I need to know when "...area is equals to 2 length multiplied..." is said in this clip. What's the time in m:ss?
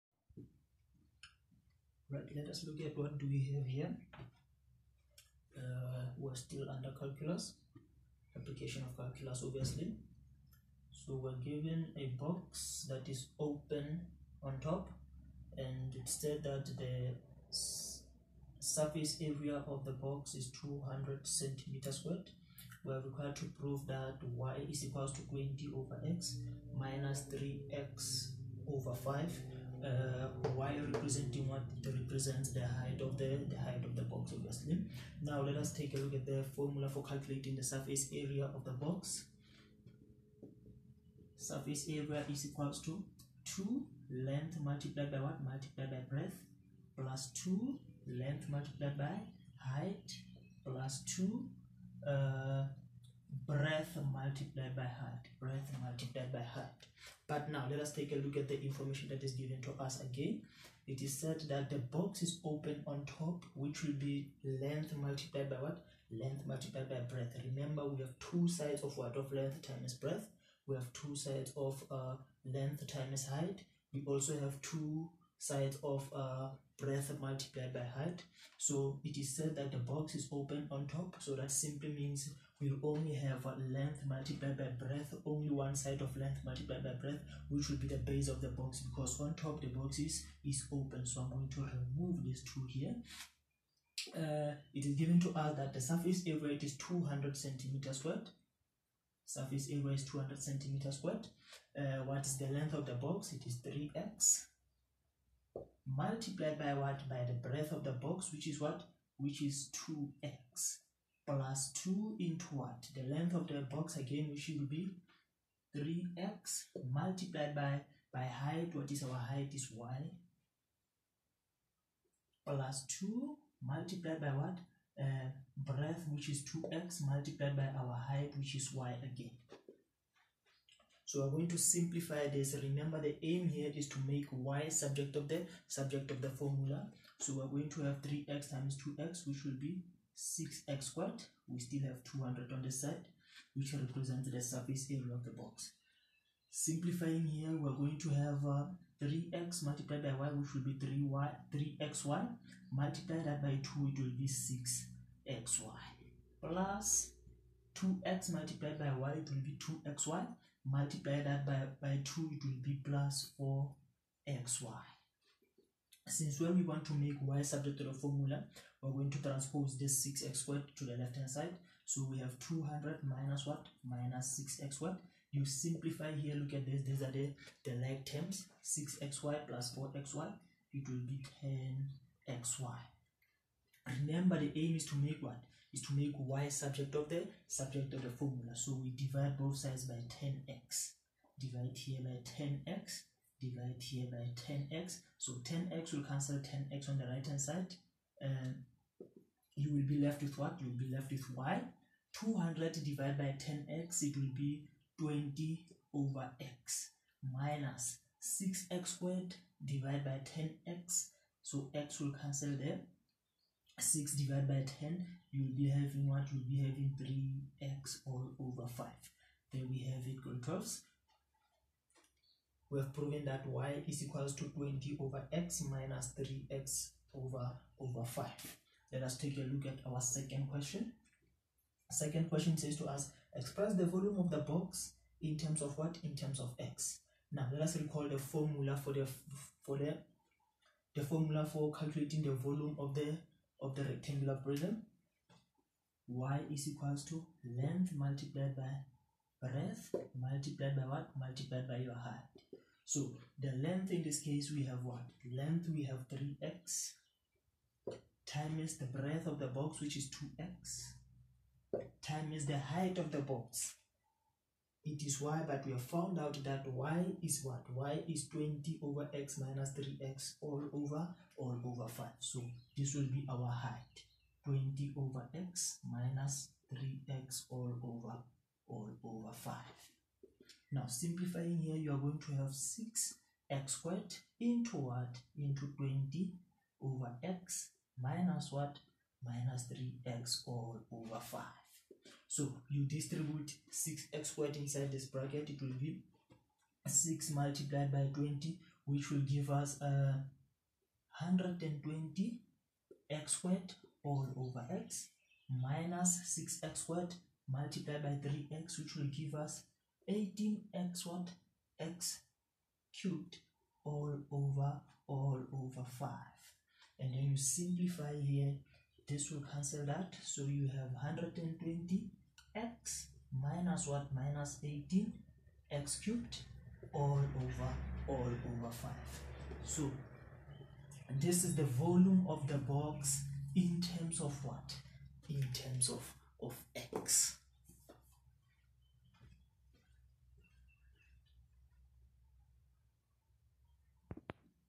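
0:41.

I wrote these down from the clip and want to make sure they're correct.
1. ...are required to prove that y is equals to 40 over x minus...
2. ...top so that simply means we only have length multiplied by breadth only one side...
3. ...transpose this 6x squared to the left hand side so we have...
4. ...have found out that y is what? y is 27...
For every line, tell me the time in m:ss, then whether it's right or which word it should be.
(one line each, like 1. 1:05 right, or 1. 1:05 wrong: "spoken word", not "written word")
1. 0:22 wrong: "20", not "40"
2. 1:20 right
3. 2:49 right
4. 4:25 wrong: "20", not "27".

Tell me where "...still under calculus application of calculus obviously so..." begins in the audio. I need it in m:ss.
0:06.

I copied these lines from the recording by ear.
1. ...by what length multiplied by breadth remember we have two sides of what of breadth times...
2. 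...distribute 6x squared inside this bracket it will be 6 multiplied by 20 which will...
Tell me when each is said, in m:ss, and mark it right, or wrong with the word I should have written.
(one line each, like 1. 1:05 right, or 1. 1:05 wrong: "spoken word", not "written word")
1. 1:05 wrong: "length", not "breadth"
2. 4:52 right.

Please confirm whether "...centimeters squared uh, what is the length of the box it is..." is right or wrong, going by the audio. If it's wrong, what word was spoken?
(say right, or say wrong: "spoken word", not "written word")
right.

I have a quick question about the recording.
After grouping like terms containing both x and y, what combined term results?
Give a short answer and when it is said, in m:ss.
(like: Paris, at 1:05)
10xy, at 3:01.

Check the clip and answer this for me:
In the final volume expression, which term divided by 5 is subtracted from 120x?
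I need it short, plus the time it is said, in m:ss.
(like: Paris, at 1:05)
18x cubed, at 5:24.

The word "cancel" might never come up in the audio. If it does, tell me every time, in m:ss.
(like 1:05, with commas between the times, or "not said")
3:16, 3:32, 5:19.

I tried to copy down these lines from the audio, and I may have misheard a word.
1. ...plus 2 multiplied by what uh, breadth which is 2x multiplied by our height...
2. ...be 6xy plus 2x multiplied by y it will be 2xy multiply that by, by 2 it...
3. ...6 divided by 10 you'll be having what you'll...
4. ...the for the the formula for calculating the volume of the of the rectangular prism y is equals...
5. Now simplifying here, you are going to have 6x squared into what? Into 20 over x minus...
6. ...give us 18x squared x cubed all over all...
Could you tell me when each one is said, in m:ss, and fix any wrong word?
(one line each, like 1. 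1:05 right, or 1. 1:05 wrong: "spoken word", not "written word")
1. 2:02 right
2. 2:34 right
3. 3:33 right
4. 3:58 right
5. 4:40 right
6. 5:09 right.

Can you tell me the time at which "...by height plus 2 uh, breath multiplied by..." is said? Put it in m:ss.
0:48.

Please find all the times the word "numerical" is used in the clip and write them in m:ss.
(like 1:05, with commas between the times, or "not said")
not said.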